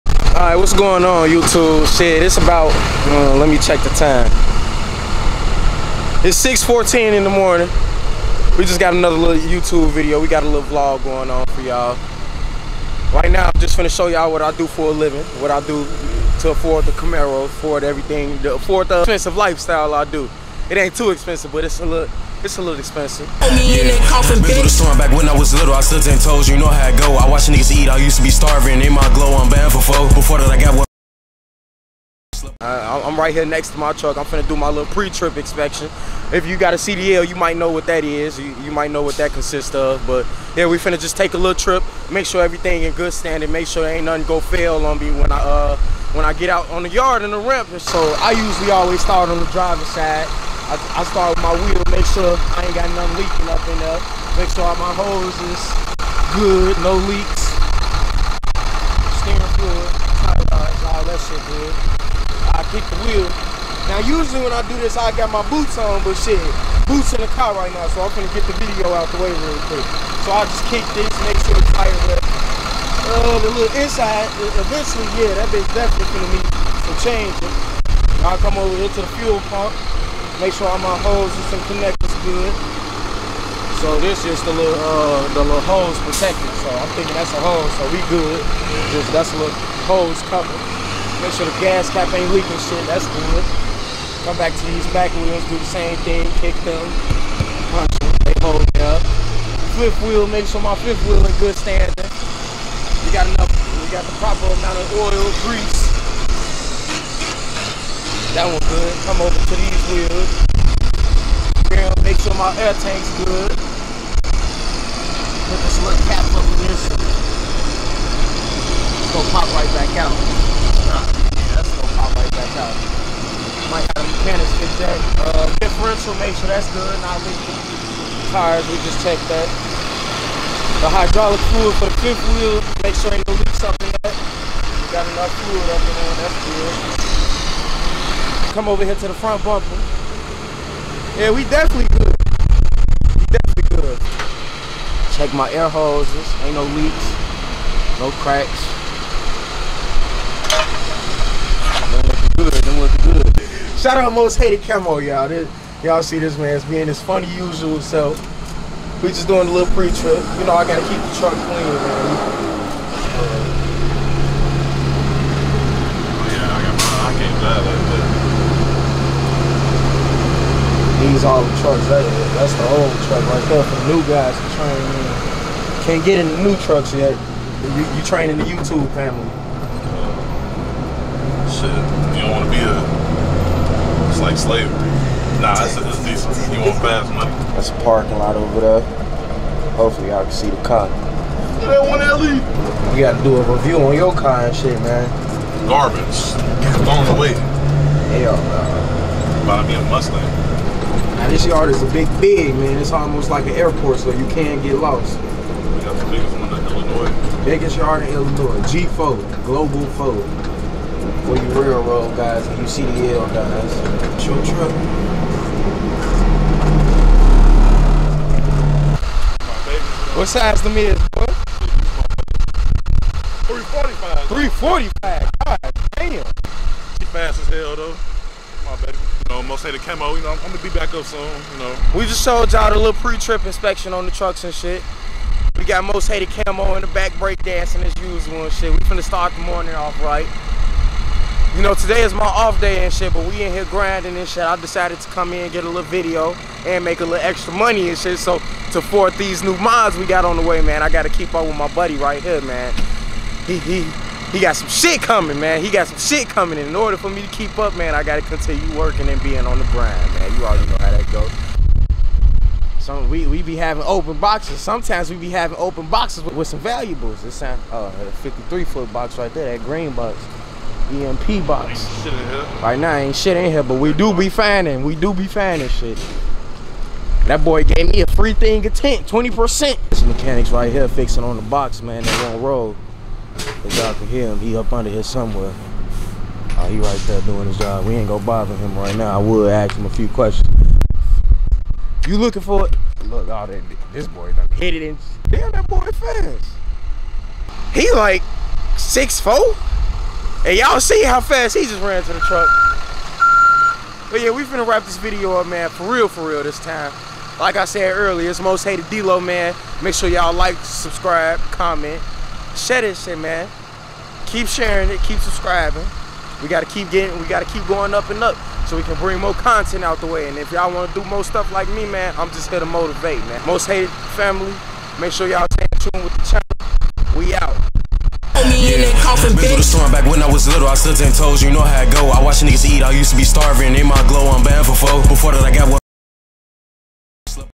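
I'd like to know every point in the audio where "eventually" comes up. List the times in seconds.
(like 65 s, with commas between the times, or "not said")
74 s.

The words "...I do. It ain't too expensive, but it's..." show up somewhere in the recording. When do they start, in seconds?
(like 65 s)
19 s.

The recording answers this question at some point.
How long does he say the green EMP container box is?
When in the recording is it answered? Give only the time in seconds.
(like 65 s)
268 s.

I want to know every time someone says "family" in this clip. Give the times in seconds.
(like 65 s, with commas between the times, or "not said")
178 s, 324 s.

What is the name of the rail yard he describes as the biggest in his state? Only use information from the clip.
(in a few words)
Global 4.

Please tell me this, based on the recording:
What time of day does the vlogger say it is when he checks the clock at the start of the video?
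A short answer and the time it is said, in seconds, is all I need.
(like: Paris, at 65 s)
6:14, at 6 s.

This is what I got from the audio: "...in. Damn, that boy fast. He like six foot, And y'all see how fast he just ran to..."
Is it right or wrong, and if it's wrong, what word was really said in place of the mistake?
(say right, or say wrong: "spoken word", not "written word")
right.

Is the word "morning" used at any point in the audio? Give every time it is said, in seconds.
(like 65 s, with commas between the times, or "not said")
7 s, 239 s.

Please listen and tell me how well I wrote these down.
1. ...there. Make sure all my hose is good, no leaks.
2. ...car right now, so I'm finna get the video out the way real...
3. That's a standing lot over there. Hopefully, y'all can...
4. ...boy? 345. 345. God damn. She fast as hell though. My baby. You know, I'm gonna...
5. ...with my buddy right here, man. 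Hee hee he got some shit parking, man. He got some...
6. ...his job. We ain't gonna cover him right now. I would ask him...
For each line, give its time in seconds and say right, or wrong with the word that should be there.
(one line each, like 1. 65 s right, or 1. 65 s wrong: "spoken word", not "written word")
1. 53 s right
2. 67 s wrong: "gonna", not "finna"
3. 187 s wrong: "parking", not "standing"
4. 221 s right
5. 251 s wrong: "coming", not "parking"
6. 287 s wrong: "bother", not "cover".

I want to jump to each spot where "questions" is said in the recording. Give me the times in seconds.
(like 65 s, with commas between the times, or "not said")
290 s.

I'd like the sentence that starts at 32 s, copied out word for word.
I'm right here next to my truck.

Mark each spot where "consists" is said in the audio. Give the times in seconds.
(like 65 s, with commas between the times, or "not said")
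39 s.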